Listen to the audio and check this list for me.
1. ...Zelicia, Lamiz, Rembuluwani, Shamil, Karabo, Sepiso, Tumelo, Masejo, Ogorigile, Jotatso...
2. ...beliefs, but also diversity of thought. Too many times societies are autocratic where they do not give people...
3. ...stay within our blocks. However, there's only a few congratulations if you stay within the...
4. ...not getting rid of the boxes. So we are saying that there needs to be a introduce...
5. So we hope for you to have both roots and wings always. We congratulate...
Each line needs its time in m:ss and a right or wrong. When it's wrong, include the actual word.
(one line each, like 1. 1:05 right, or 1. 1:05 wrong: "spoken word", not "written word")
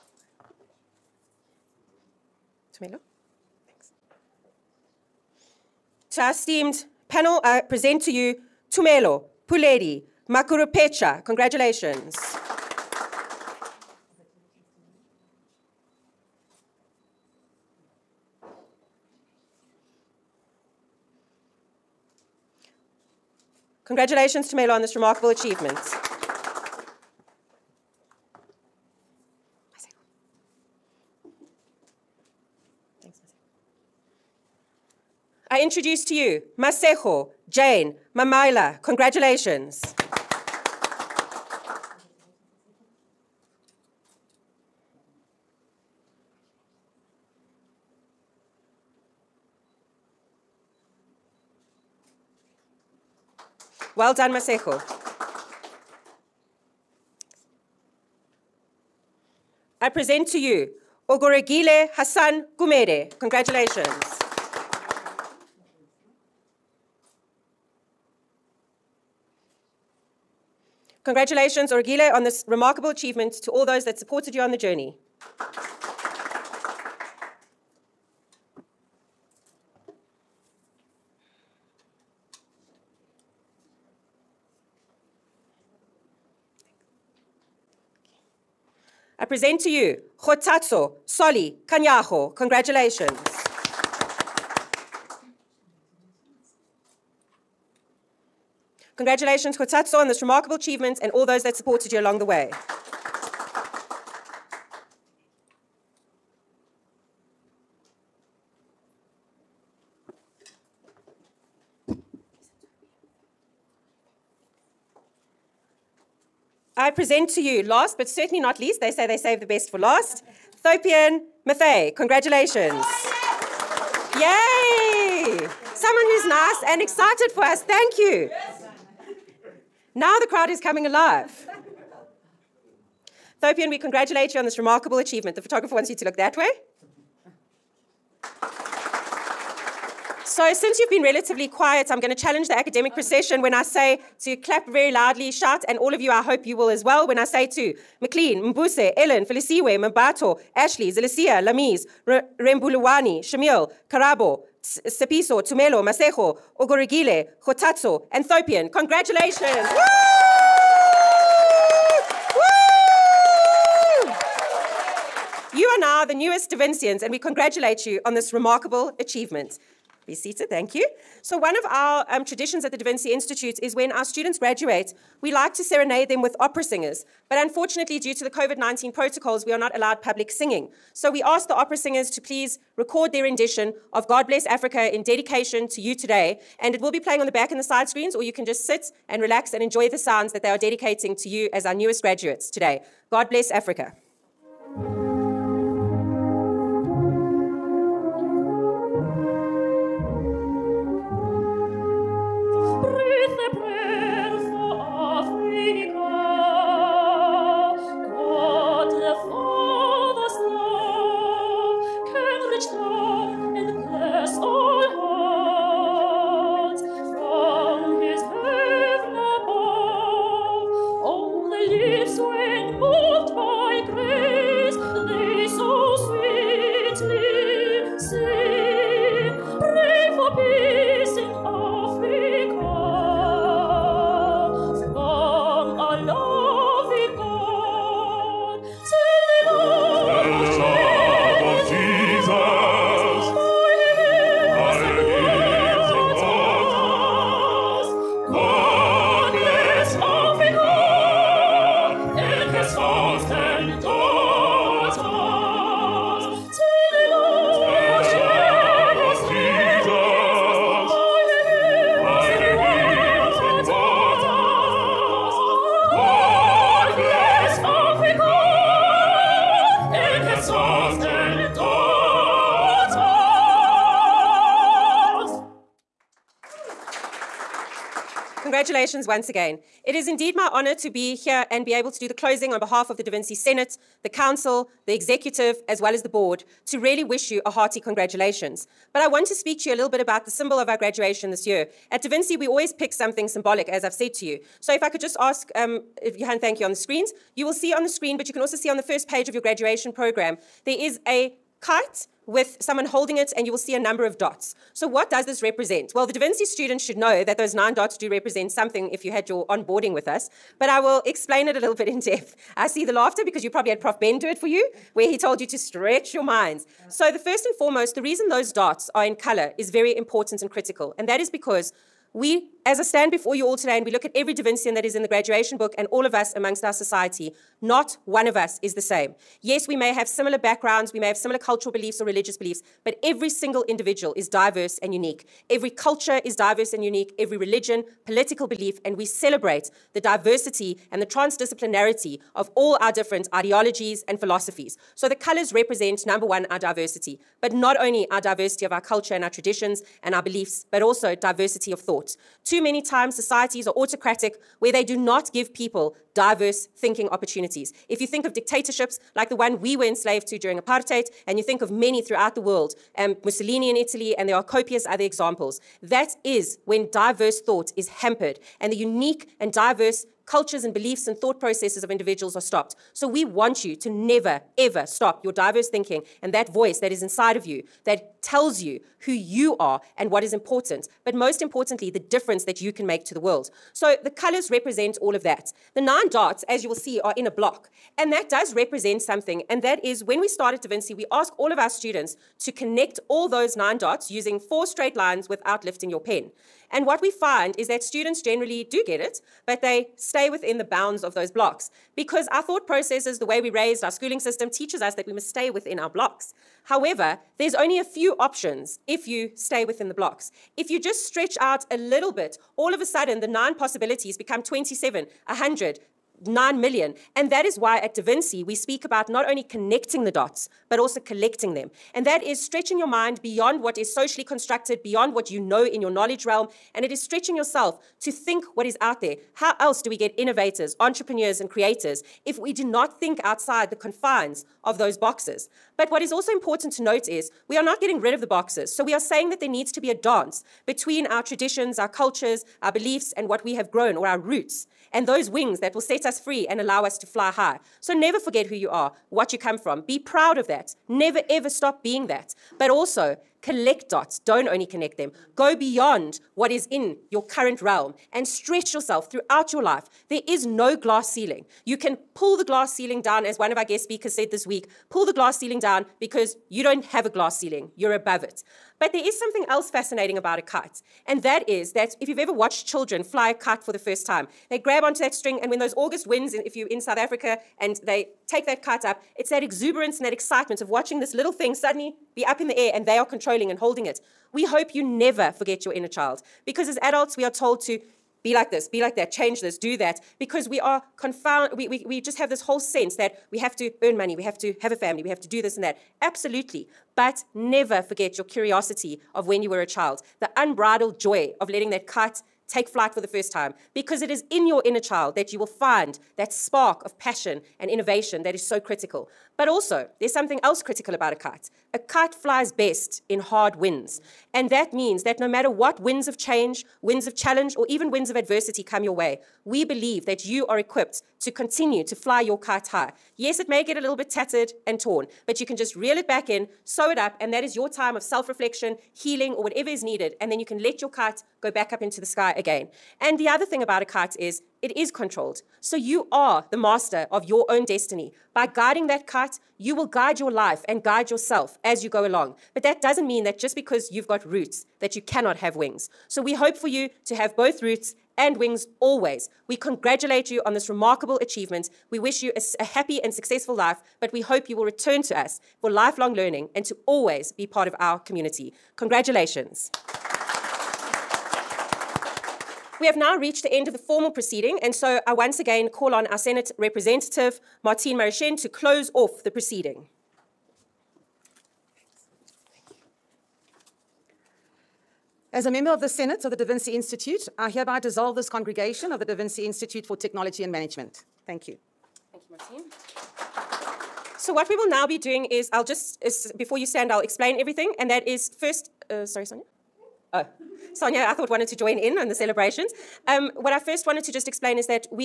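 1. 2:30 right
2. 5:50 right
3. 6:45 wrong: "options", not "congratulations"
4. 7:17 wrong: "dance", not "introduce"
5. 9:06 right.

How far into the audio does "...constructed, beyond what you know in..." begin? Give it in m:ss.
7:04.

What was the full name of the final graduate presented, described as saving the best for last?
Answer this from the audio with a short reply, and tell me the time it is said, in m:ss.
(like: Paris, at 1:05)
Thopian Mathay, at 2:00.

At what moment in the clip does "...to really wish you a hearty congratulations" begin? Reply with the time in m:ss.
4:46.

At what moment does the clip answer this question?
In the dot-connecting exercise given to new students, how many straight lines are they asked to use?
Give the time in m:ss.
6:34.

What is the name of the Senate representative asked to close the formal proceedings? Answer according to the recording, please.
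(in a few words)
Martine Marichin.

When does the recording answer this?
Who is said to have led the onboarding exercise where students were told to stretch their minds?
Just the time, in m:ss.
5:13.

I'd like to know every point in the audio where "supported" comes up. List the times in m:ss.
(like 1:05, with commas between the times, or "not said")
1:13, 1:41.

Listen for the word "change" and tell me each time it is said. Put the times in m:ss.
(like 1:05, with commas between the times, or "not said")
8:09, 8:36.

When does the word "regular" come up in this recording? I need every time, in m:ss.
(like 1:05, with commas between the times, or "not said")
not said.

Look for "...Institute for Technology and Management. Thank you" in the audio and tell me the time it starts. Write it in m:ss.
9:39.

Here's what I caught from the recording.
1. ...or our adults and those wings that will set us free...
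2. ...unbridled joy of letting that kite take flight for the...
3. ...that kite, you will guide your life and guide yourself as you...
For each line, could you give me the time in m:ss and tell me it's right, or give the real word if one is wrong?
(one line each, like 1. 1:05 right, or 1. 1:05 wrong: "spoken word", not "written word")
1. 7:23 wrong: "roots", not "adults"
2. 8:20 right
3. 8:58 right.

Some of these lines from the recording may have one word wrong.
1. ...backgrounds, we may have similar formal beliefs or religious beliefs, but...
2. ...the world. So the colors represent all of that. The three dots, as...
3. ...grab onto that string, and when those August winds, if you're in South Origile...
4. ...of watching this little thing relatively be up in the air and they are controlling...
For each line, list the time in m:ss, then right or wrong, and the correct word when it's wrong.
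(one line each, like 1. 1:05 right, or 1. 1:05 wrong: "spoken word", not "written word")
1. 5:30 wrong: "cultural", not "formal"
2. 6:23 wrong: "nine", not "three"
3. 7:54 wrong: "Africa", not "Origile"
4. 8:00 wrong: "suddenly", not "relatively".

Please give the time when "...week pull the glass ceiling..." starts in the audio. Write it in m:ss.
7:44.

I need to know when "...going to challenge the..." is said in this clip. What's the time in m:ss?
2:22.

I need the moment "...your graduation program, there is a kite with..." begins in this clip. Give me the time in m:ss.
4:59.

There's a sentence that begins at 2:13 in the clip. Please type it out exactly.
Thopian, we congratulate you on this remarkable achievement.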